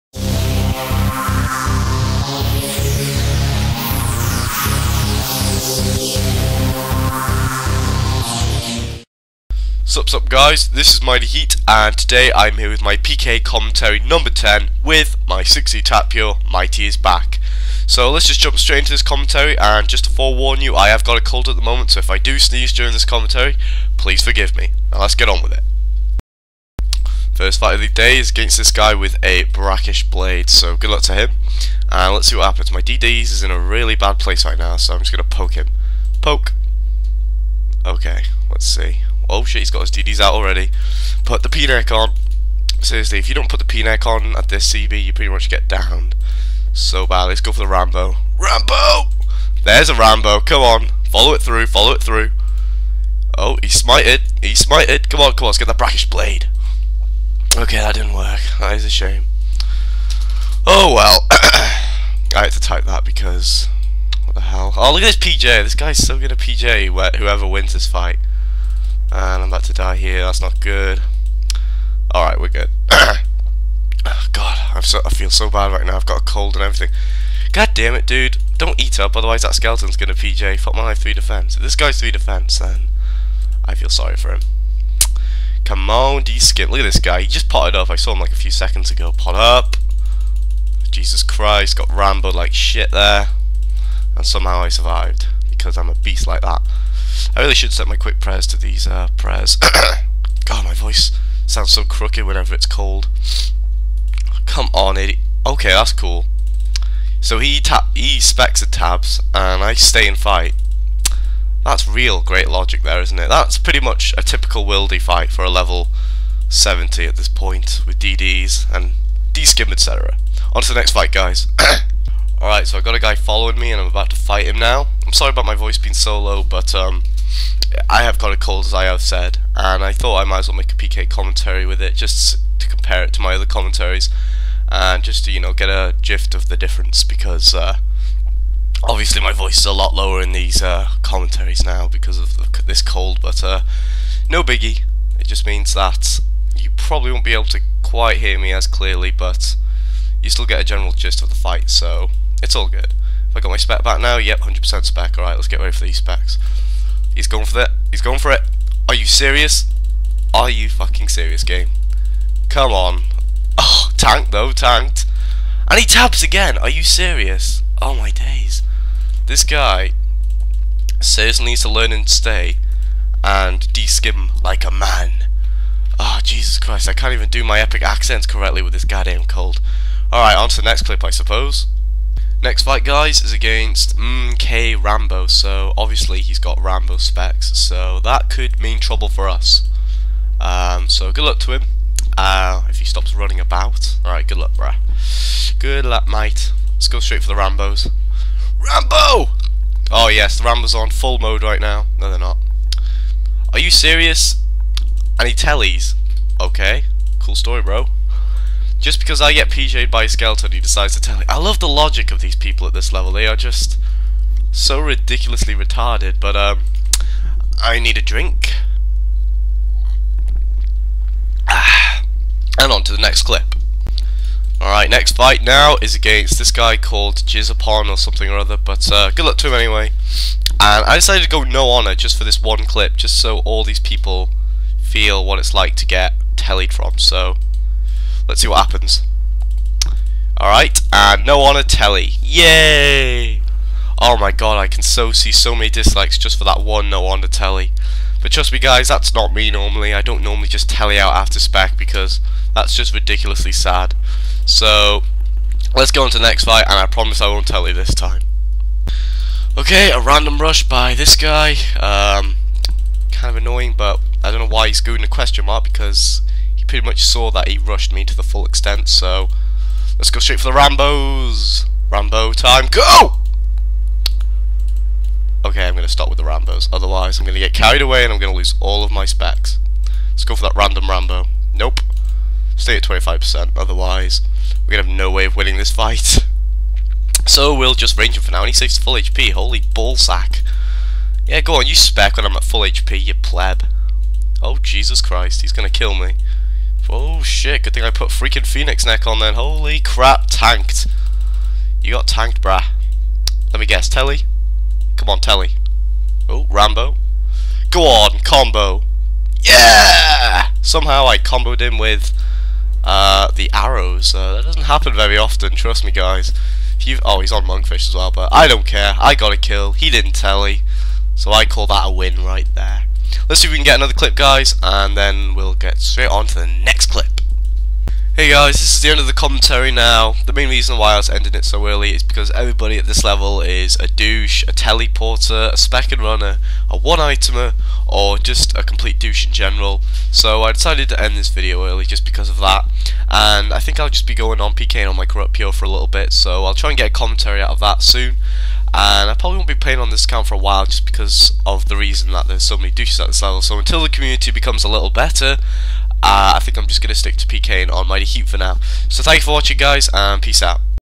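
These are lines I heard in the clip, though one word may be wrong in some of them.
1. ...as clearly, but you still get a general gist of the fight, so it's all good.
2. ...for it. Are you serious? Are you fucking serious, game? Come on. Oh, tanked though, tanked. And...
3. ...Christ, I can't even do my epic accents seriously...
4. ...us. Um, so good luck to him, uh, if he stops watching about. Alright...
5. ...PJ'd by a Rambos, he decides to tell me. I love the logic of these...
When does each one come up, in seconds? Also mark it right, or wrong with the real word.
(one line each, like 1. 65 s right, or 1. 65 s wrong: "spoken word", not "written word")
1. 148 s right
2. 158 s right
3. 176 s wrong: "correctly", not "seriously"
4. 189 s wrong: "running", not "watching"
5. 209 s wrong: "Skeleton", not "Rambos".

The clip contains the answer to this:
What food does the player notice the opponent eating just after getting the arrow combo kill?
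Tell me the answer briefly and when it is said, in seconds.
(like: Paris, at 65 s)
Monkfish, at 317 s.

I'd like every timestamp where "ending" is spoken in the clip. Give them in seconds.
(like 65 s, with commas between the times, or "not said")
331 s.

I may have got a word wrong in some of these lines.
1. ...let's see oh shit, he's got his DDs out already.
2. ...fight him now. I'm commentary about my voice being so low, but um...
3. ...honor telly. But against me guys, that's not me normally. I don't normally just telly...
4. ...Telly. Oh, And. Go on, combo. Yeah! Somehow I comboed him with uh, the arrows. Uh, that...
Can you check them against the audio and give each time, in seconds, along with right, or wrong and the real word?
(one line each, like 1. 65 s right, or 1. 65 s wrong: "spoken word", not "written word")
1. 38 s right
2. 124 s wrong: "sorry", not "commentary"
3. 247 s wrong: "trust", not "against"
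4. 305 s wrong: "Rambo", not "And".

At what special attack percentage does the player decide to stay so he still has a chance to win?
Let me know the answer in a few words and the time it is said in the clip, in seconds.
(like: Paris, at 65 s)
25%, at 282 s.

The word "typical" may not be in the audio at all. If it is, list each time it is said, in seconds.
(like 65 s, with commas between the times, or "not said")
114 s.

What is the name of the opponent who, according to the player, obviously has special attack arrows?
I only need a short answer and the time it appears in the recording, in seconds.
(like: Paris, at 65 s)
MK Rambo, at 183 s.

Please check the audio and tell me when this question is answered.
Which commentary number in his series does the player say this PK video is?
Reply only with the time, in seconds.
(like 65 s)
13 s.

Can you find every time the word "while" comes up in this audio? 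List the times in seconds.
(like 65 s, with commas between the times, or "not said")
350 s.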